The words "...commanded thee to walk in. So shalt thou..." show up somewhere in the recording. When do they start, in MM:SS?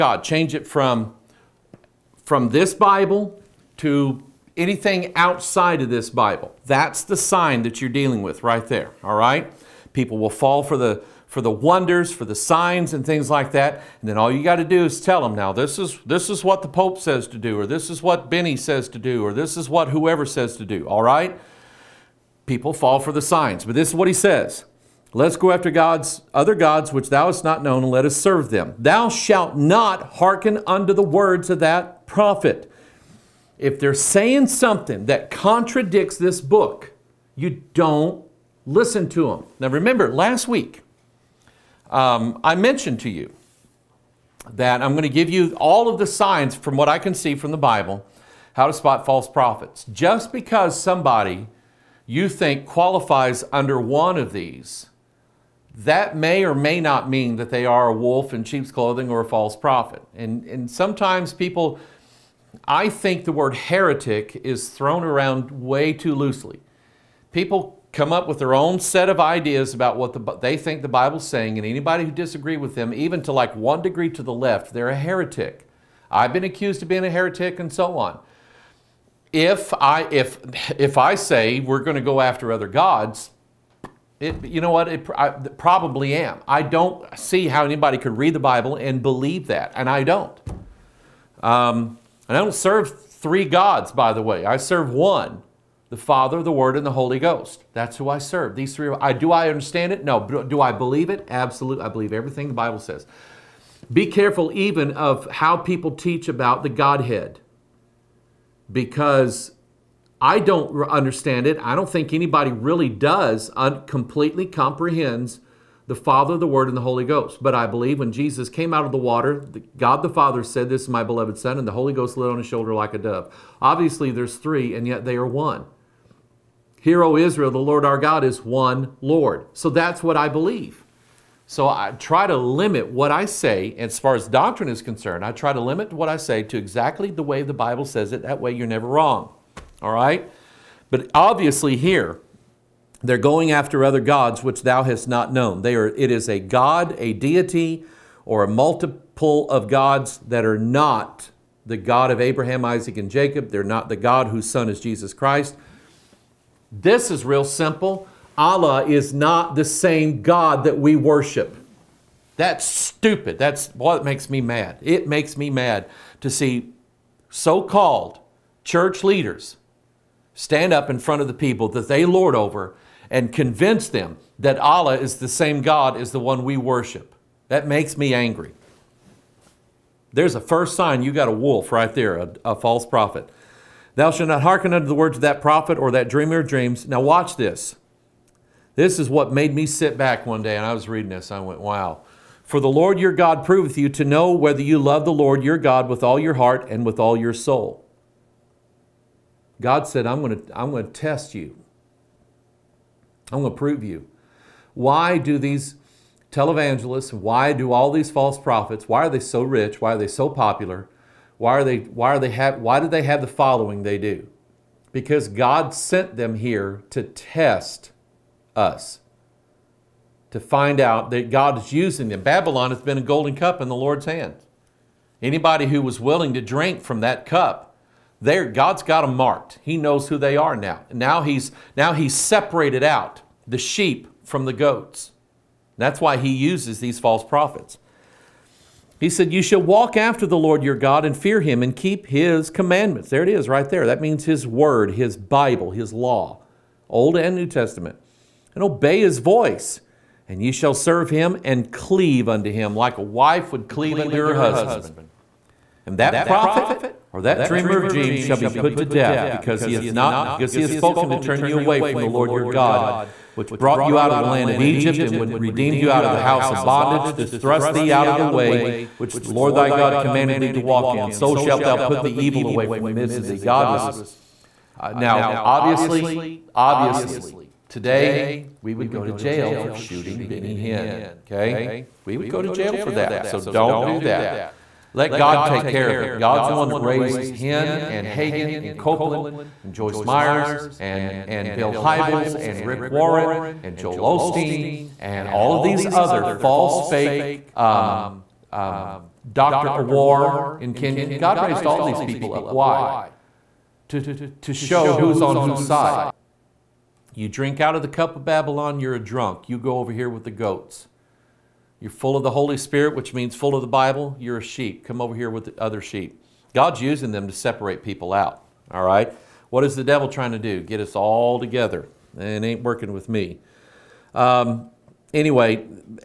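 04:29.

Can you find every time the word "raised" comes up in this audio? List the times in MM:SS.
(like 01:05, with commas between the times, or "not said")
04:46, 05:01.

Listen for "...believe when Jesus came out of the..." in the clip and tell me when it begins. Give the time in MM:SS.
01:57.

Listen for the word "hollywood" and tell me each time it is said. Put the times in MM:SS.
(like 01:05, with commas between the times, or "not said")
not said.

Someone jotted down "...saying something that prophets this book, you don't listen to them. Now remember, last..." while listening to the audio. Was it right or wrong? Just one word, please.
wrong.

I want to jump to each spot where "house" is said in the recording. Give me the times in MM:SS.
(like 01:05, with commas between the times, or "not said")
04:26.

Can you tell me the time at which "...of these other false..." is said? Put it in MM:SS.
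04:55.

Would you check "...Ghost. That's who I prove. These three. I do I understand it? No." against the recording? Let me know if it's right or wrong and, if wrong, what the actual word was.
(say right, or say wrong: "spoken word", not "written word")
wrong: "serve", not "prove".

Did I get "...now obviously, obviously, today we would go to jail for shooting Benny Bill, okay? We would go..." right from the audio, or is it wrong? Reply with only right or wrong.
wrong.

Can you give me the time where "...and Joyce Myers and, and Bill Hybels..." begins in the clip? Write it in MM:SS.
04:49.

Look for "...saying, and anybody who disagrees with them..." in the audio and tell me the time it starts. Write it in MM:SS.
01:11.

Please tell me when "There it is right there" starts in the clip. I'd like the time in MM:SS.
04:03.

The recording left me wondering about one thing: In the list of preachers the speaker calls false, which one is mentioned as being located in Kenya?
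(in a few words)
Dr. Owuor.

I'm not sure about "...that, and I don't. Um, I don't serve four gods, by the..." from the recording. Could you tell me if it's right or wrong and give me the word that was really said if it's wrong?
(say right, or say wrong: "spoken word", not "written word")
wrong: "three", not "four".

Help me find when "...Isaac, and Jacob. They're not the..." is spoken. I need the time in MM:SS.
02:32.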